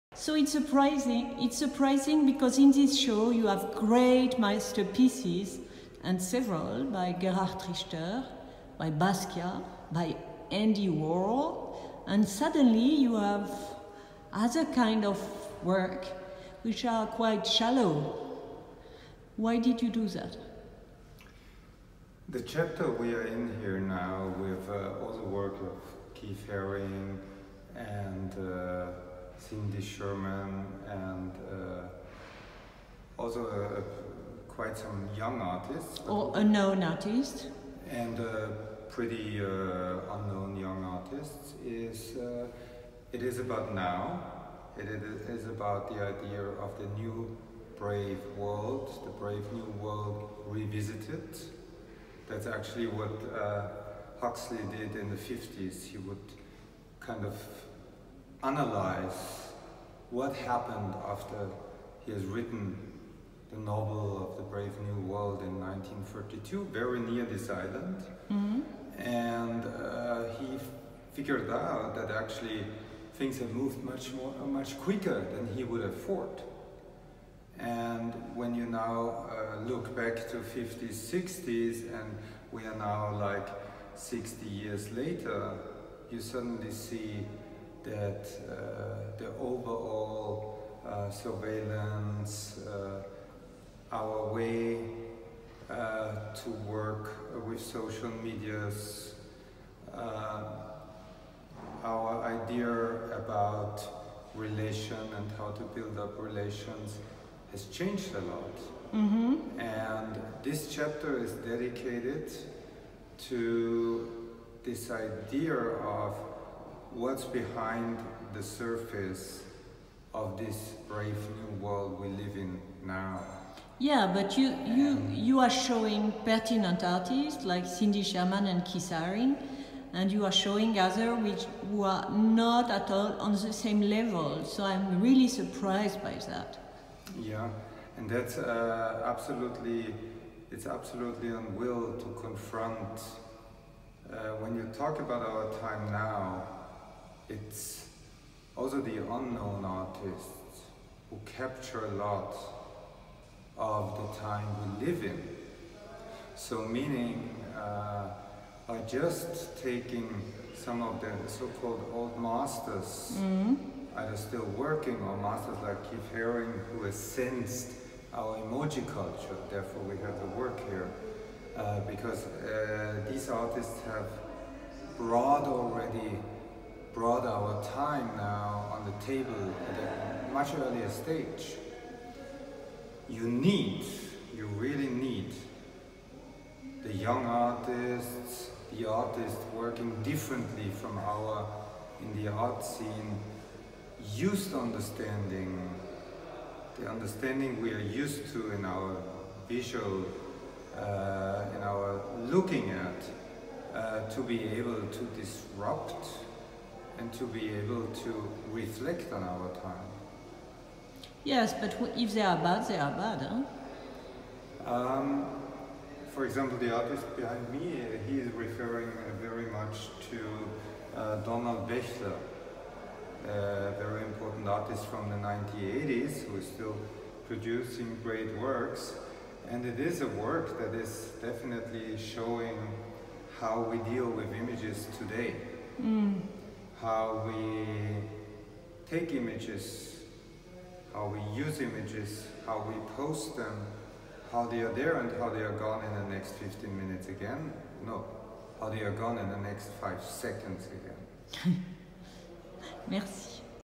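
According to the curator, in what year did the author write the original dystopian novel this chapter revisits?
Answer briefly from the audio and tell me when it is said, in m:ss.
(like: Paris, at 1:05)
1932, at 1:05.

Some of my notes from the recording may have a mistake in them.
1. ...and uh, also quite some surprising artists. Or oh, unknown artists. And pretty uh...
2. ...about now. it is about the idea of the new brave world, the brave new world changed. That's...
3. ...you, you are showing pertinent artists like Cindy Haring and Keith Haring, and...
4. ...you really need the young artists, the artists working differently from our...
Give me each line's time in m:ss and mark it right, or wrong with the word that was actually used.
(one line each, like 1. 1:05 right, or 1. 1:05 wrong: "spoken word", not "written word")
1. 0:30 wrong: "young", not "surprising"
2. 0:43 wrong: "revisited", not "changed"
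3. 2:04 wrong: "Sherman", not "Haring"
4. 3:04 right.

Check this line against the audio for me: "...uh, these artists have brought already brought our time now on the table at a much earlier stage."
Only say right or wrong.
right.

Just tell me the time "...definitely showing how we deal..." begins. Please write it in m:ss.
3:51.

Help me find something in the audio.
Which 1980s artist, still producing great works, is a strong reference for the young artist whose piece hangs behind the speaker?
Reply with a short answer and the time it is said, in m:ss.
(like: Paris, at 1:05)
Donald Baechler, at 3:41.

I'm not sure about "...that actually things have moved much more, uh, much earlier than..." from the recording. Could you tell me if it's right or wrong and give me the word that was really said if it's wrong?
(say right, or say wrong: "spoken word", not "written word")
wrong: "quicker", not "earlier".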